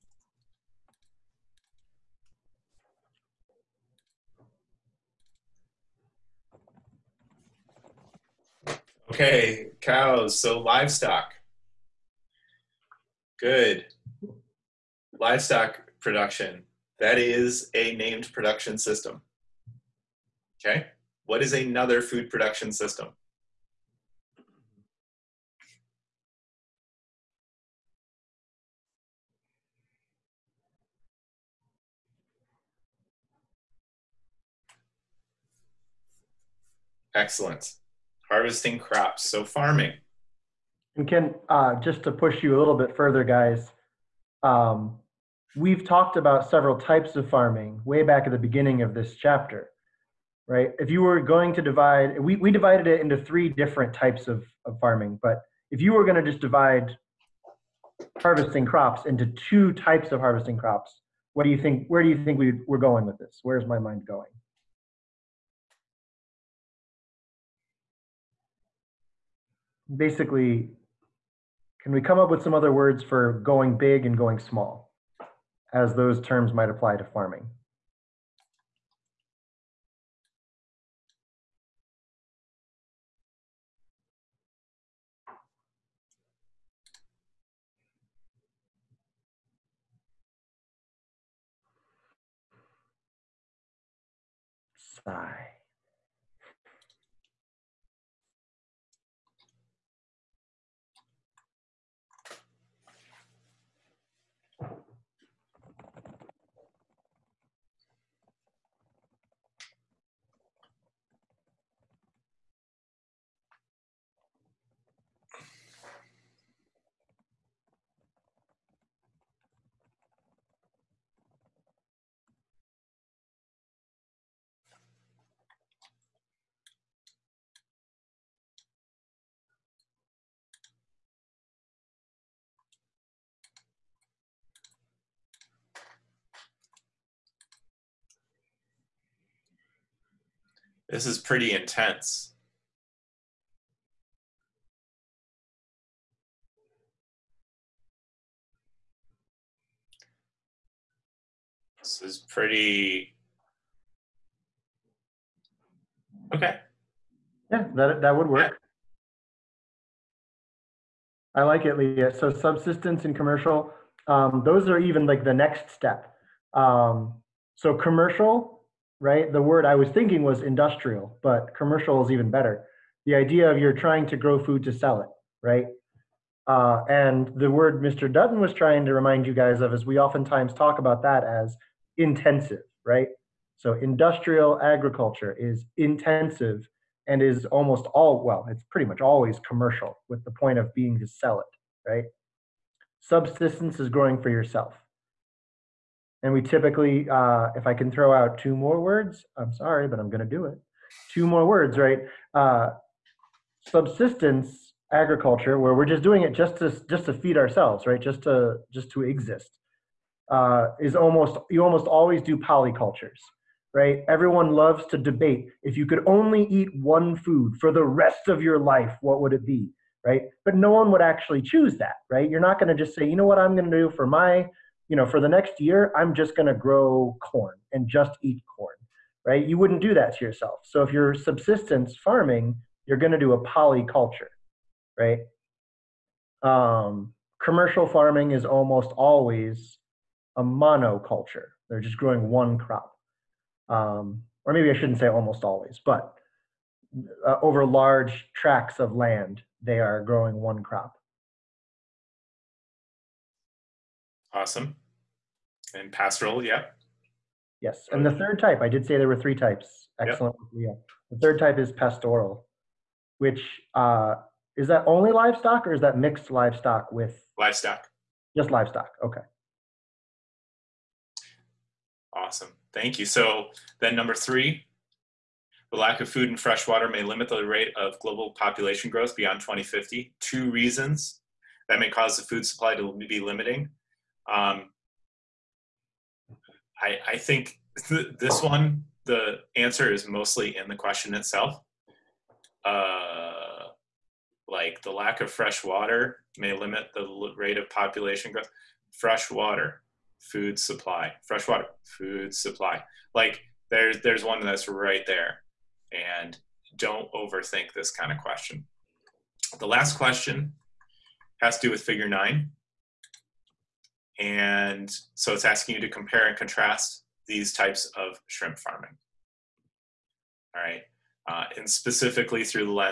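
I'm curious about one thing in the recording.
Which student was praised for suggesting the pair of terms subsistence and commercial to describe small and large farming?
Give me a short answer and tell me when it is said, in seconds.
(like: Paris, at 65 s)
Leah, at 161 s.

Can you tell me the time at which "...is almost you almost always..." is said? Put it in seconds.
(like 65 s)
210 s.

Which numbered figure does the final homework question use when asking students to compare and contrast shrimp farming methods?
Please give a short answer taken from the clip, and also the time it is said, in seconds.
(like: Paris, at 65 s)
figure 9, at 311 s.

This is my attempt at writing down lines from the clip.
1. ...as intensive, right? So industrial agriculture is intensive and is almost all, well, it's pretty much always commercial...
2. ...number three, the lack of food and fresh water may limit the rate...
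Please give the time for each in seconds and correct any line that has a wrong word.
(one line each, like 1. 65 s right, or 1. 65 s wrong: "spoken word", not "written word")
1. 181 s right
2. 273 s right.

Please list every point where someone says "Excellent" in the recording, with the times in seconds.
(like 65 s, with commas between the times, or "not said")
37 s, 260 s.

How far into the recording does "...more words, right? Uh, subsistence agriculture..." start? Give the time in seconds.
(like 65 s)
201 s.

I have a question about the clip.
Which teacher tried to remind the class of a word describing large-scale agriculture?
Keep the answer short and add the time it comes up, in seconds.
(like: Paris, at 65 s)
Mr. Dutton, at 177 s.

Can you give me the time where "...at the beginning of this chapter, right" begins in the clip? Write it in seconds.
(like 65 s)
48 s.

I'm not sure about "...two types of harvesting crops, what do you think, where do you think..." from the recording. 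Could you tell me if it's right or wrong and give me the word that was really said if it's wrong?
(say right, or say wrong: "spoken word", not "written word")
right.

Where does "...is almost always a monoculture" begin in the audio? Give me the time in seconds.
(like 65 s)
238 s.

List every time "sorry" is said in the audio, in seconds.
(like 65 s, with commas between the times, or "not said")
199 s.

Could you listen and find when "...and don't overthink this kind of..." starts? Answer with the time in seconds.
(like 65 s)
305 s.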